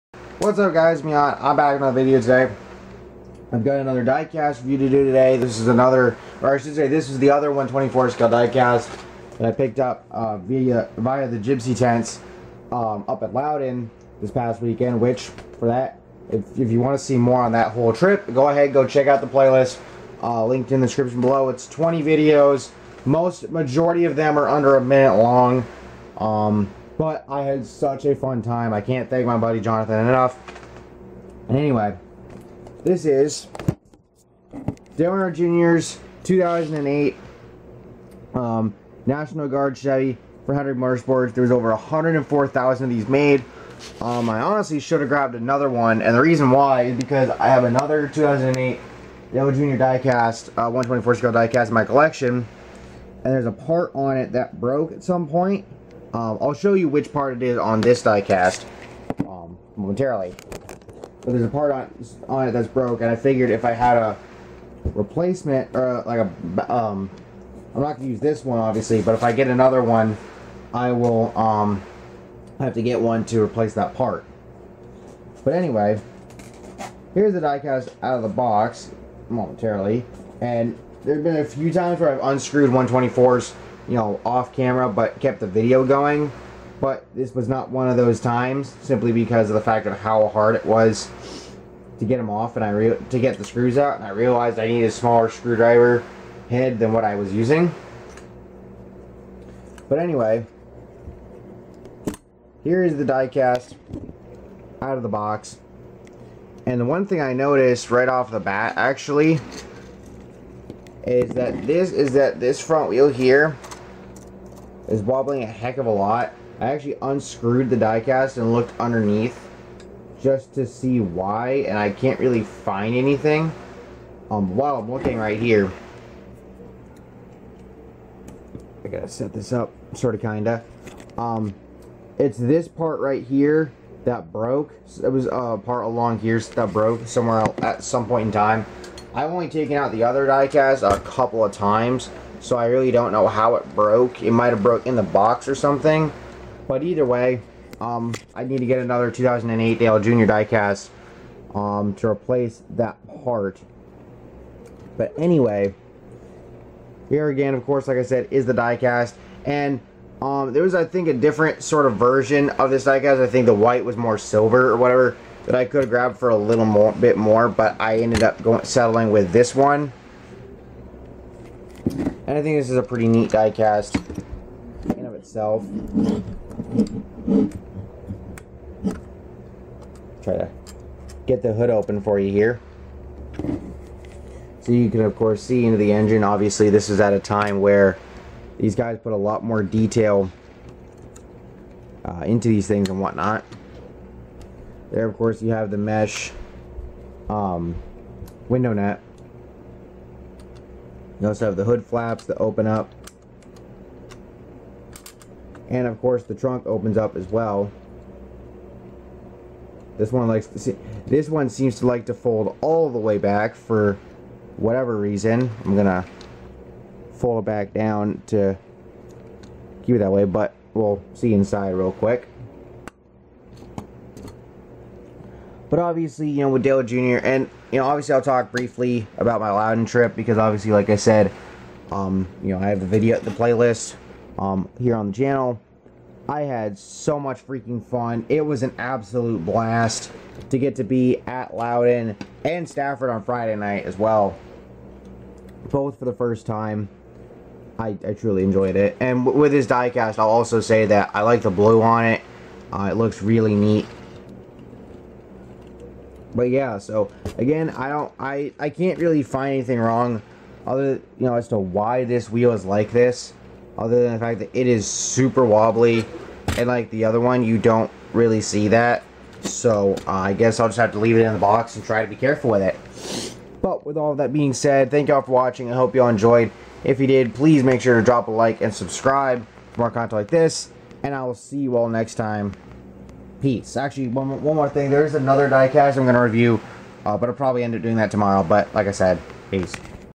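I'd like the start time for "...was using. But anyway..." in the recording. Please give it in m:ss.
1:37.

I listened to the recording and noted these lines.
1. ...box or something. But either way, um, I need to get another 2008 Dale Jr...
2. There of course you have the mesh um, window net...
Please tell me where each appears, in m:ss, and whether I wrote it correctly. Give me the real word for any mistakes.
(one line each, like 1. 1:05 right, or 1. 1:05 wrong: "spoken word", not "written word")
1. 2:25 right
2. 3:14 right.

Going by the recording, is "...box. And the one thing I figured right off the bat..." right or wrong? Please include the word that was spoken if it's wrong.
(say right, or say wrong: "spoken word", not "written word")
wrong: "noticed", not "figured".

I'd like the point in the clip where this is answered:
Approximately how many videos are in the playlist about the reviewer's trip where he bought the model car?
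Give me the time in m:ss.
0:21.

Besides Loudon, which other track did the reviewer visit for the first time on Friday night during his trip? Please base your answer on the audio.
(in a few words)
Stafford.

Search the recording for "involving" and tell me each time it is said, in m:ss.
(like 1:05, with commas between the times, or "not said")
not said.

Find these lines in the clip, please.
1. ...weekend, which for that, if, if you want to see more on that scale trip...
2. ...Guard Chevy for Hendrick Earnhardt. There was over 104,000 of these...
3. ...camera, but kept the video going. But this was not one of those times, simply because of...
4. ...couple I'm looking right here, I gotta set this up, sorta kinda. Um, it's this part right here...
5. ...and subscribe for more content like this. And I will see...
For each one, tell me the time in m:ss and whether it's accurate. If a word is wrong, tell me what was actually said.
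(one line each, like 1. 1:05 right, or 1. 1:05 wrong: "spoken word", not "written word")
1. 0:14 wrong: "whole", not "scale"
2. 0:39 wrong: "Motorsports", not "Earnhardt"
3. 1:24 right
4. 2:04 wrong: "while", not "couple"
5. 4:38 right.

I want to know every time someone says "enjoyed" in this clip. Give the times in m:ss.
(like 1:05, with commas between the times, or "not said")
4:08, 4:36.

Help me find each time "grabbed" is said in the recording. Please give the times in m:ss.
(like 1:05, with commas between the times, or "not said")
0:45, 2:45.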